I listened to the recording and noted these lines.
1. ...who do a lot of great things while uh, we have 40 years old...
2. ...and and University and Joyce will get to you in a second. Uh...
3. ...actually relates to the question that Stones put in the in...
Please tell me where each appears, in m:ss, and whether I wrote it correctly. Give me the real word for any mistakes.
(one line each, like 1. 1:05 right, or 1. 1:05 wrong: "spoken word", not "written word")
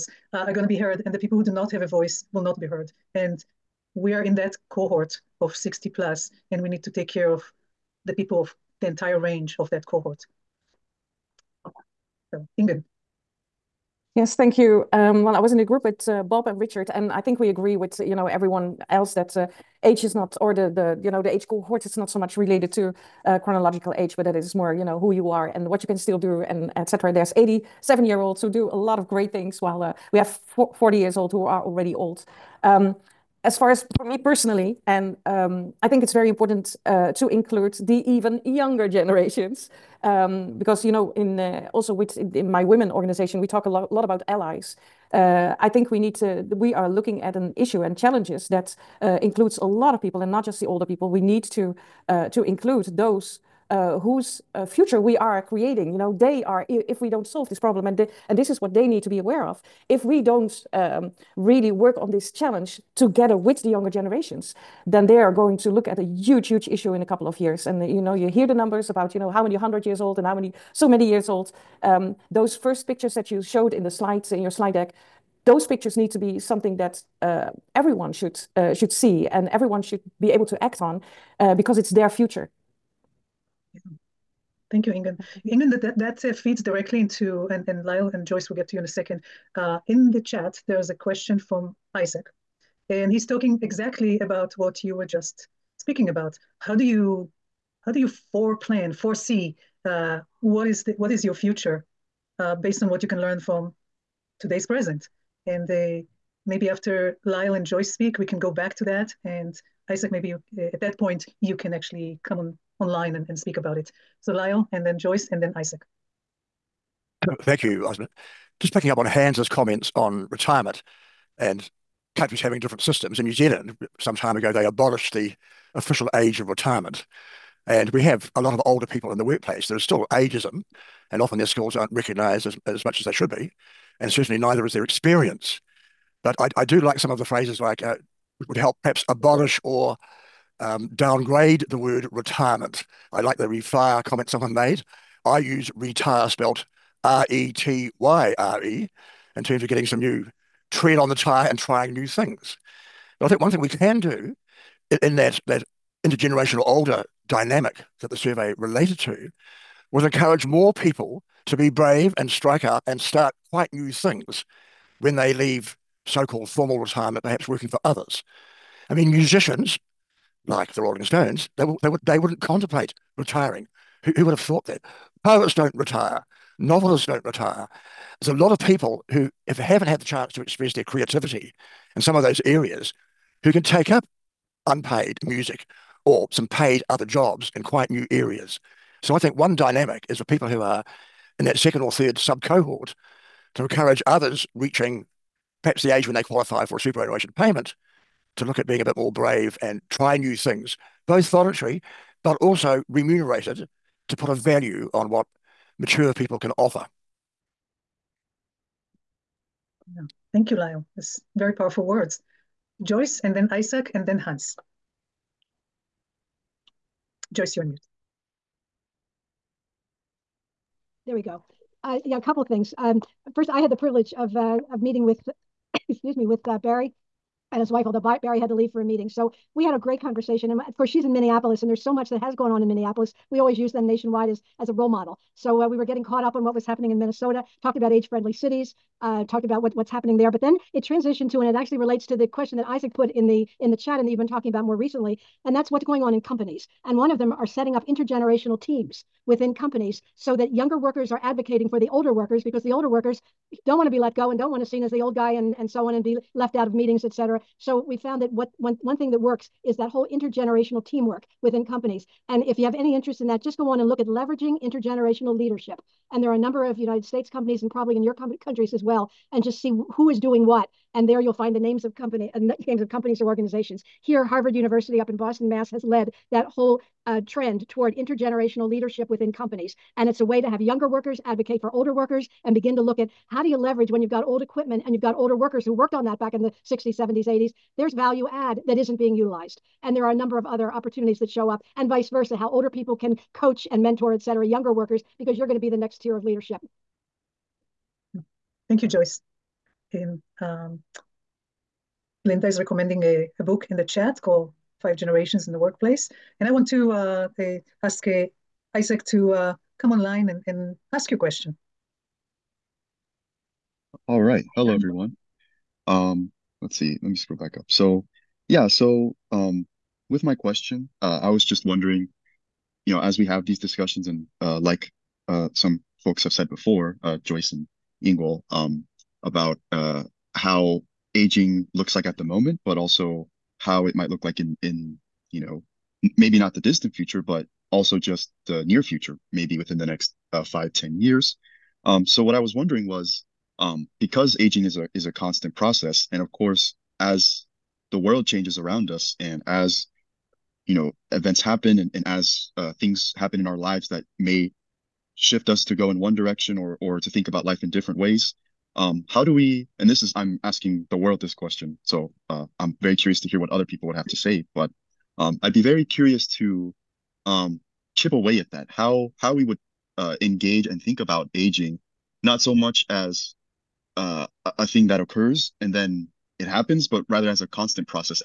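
1. 0:28 right
2. 1:27 wrong: "Lyle", not "University"
3. 4:01 wrong: "Isaac", not "Stones".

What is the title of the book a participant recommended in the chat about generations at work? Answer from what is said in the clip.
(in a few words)
Five Generations in the Workplace.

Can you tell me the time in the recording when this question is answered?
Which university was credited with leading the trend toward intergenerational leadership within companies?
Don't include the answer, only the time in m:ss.
4:34.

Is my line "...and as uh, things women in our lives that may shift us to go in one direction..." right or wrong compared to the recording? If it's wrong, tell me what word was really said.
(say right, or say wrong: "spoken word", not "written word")
wrong: "happen", not "women".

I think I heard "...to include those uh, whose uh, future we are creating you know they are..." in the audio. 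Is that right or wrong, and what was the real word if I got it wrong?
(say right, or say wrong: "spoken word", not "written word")
right.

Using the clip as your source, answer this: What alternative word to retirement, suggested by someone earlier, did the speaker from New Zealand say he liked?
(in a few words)
refire.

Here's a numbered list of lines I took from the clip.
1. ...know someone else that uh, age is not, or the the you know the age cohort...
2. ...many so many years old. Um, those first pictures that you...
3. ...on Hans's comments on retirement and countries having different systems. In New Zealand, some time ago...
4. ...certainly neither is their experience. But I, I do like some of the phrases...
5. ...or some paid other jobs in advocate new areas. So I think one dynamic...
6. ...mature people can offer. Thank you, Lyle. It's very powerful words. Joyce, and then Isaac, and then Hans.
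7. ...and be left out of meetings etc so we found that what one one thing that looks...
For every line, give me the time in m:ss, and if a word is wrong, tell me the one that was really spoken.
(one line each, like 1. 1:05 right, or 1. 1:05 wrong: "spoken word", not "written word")
1. 0:18 wrong: "everyone", not "someone"
2. 1:10 right
3. 1:58 right
4. 2:14 right
5. 3:06 wrong: "quite", not "advocate"
6. 3:25 right
7. 4:15 wrong: "works", not "looks".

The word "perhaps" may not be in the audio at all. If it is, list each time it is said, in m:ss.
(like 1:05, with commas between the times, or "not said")
2:18, 2:47, 3:15.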